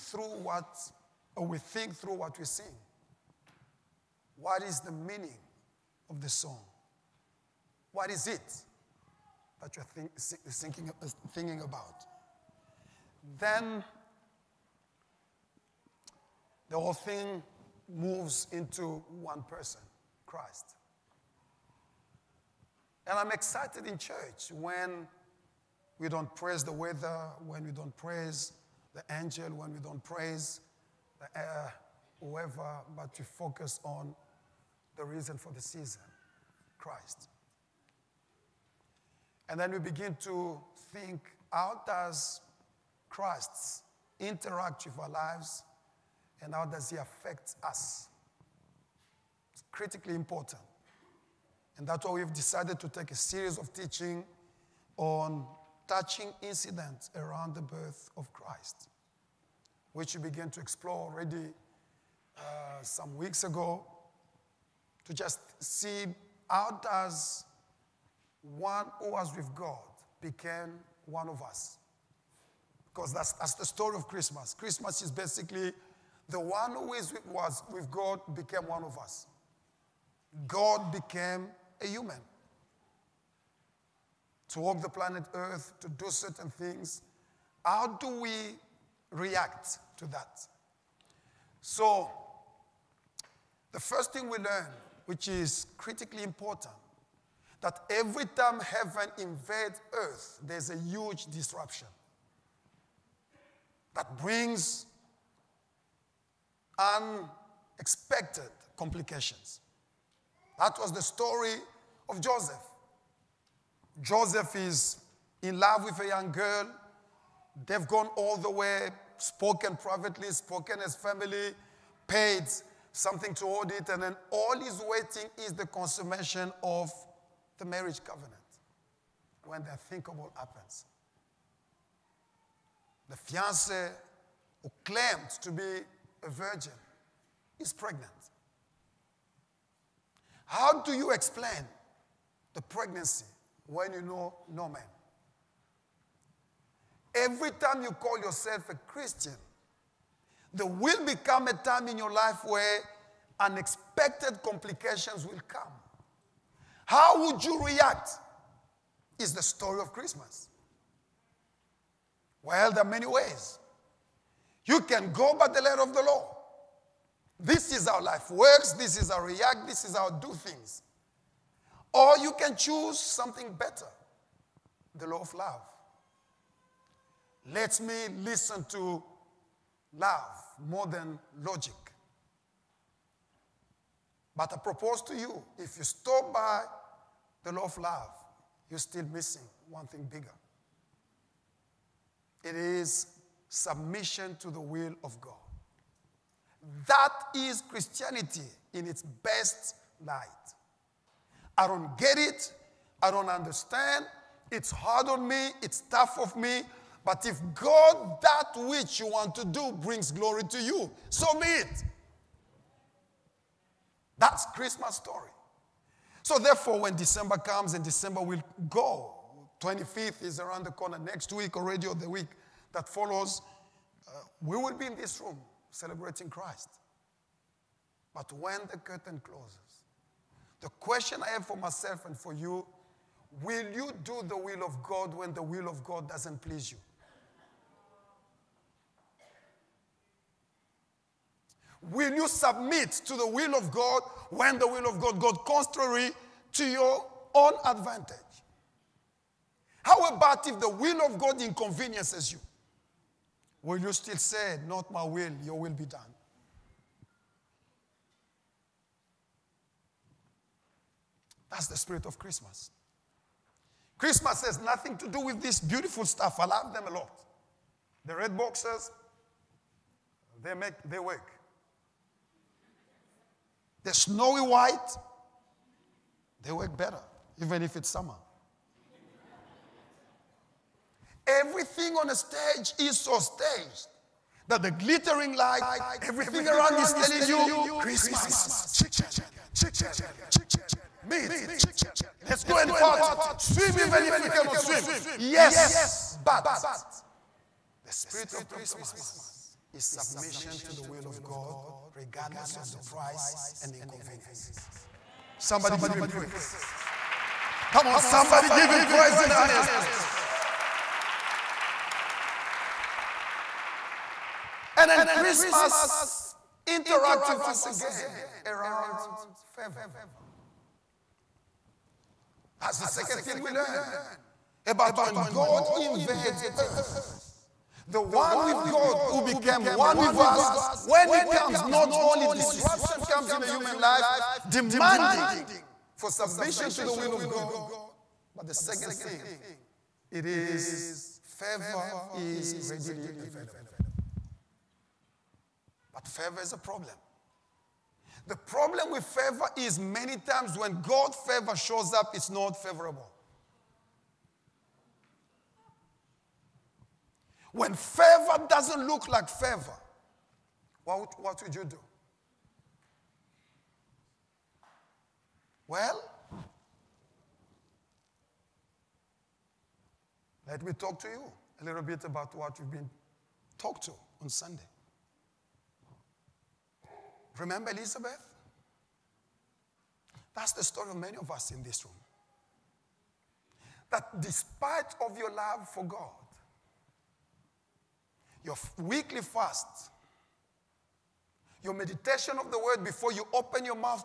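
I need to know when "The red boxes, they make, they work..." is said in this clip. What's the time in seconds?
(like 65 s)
268 s.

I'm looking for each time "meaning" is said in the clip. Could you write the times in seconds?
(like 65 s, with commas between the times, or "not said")
4 s.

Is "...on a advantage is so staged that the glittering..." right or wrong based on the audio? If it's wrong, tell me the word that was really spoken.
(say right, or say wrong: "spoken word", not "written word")
wrong: "stage", not "advantage".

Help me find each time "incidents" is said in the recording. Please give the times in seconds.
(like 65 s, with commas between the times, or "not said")
56 s.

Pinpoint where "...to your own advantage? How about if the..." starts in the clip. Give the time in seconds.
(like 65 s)
246 s.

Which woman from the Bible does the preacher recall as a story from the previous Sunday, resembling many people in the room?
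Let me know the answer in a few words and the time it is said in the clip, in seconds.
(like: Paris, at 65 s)
Elizabeth, at 377 s.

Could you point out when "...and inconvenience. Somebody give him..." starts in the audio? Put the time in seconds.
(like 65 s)
303 s.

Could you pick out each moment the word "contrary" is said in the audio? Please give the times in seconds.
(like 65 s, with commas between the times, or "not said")
245 s.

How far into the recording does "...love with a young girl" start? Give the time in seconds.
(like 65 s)
115 s.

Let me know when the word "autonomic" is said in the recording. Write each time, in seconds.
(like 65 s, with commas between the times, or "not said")
not said.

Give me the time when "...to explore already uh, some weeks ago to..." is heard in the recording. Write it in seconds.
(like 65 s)
60 s.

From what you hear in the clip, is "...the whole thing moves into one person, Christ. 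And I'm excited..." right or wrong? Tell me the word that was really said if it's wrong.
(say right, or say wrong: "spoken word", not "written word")
right.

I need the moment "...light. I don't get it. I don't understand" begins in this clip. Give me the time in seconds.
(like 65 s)
200 s.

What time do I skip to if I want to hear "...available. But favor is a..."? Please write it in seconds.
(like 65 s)
343 s.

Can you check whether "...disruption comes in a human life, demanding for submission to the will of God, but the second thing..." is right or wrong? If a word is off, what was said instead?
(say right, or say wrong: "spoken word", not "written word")
right.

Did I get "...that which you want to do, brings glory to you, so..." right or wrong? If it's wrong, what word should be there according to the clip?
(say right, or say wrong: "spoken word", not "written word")
right.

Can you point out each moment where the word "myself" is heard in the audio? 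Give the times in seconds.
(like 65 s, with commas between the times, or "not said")
231 s.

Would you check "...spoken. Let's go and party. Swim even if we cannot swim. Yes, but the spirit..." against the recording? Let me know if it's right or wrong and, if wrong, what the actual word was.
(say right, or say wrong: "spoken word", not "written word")
wrong: "chicken", not "spoken".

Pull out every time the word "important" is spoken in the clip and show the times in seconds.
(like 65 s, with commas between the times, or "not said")
50 s, 96 s.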